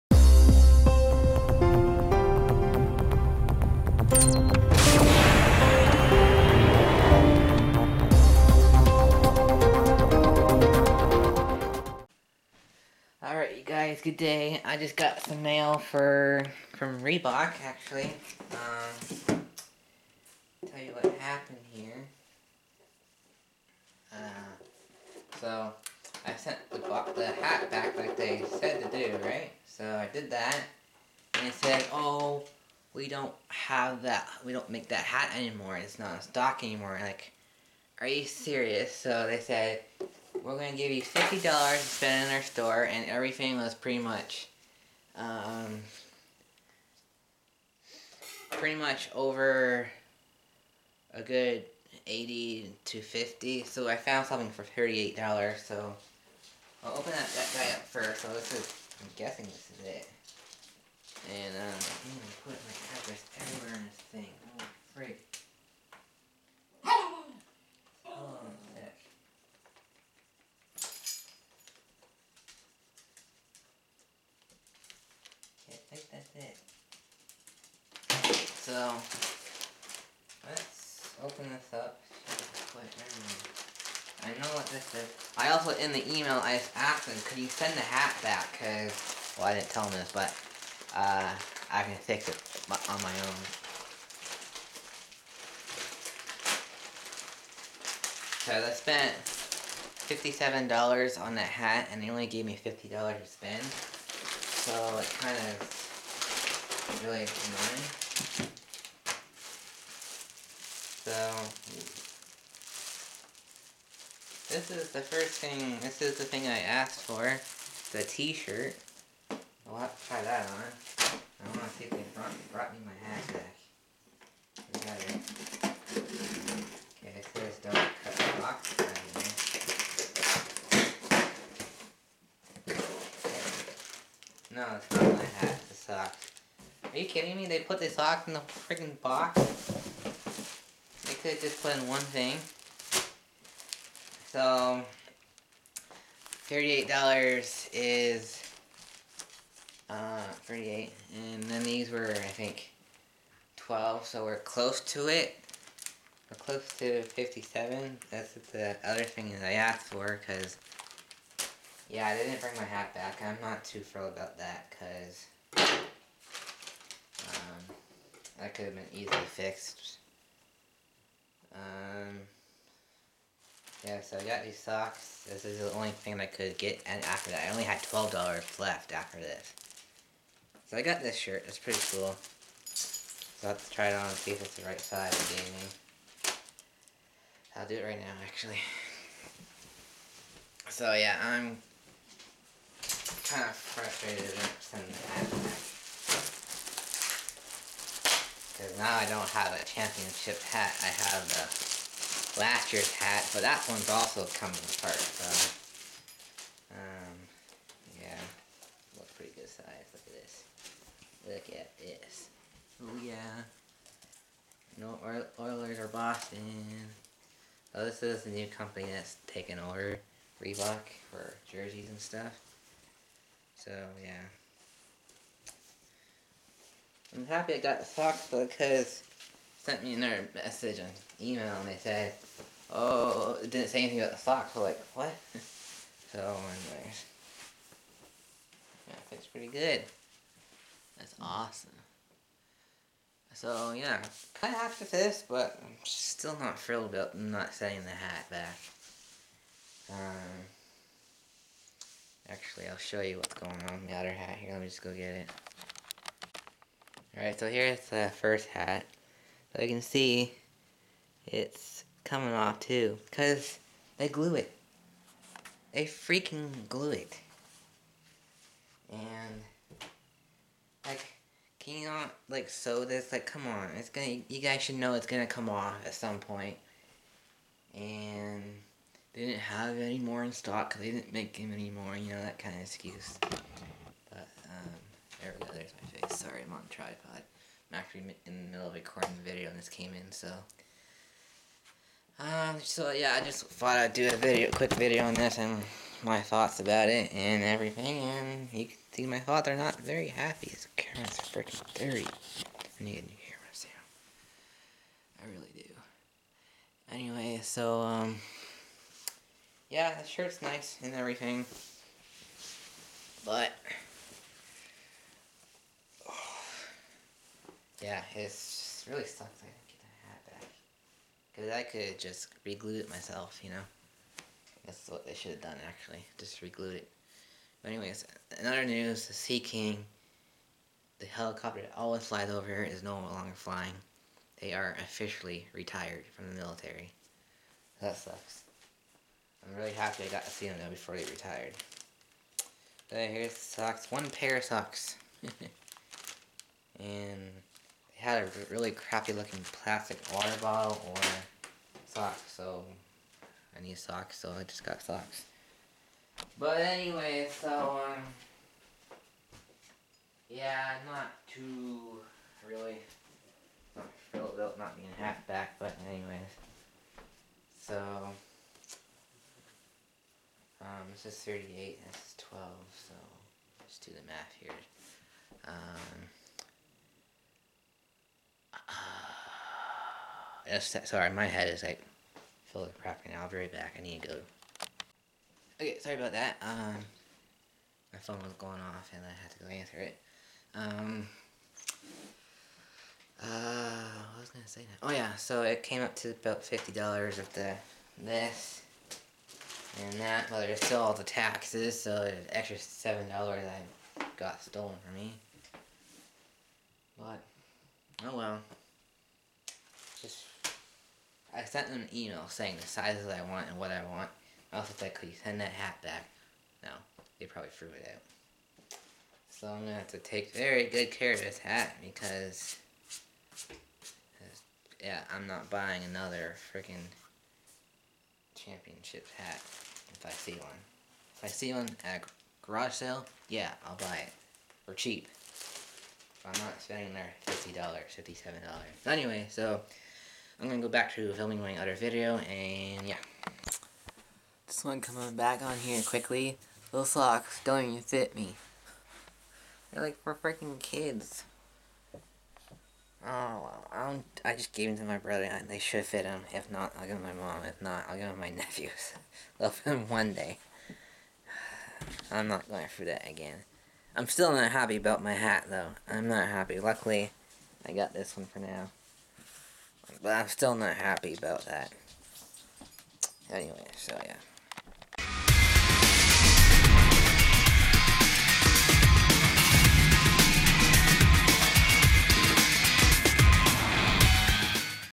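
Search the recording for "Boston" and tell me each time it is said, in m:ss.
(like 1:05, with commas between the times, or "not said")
3:35.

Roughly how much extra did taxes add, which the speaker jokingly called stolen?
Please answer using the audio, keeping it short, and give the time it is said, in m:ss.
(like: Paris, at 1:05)
$7, at 6:42.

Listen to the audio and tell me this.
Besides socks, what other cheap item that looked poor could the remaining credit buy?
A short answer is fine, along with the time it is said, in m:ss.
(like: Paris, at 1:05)
Plastic water bottle, at 5:49.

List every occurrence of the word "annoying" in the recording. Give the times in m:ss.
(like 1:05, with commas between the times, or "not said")
1:47.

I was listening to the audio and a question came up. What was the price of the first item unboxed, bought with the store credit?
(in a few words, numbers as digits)
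$38.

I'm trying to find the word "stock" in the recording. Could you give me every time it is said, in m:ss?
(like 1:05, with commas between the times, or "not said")
0:36, 4:40.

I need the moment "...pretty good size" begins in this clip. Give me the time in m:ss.
3:29.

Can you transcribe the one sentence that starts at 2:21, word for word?
They could have just put in one thing.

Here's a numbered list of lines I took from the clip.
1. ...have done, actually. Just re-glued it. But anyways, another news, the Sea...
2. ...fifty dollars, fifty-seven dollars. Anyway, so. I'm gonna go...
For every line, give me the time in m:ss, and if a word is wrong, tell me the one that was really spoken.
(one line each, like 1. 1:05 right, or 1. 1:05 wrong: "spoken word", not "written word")
1. 5:25 right
2. 7:17 right.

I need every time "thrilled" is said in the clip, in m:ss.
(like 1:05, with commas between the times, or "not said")
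2:43, 4:06.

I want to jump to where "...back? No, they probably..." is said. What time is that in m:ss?
6:55.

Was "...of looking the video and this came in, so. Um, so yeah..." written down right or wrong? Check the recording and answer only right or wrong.
wrong.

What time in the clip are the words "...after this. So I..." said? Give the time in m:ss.
2:58.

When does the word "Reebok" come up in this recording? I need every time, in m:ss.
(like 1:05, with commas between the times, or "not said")
0:17, 3:40.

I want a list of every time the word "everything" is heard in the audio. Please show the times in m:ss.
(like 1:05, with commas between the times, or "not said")
0:43, 4:57, 5:10.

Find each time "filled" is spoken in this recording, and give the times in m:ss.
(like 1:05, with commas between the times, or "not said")
6:04.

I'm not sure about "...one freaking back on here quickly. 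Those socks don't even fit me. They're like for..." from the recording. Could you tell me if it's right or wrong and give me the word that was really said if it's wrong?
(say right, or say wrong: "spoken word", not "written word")
wrong: "coming", not "freaking".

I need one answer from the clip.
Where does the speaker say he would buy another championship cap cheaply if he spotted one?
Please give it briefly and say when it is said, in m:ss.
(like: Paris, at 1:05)
Garage sale, at 7:12.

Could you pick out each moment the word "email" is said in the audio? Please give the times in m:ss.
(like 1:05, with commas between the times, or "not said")
1:26, 3:51, 6:51.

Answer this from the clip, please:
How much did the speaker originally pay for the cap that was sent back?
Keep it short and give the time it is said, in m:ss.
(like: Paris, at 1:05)
$57, at 1:39.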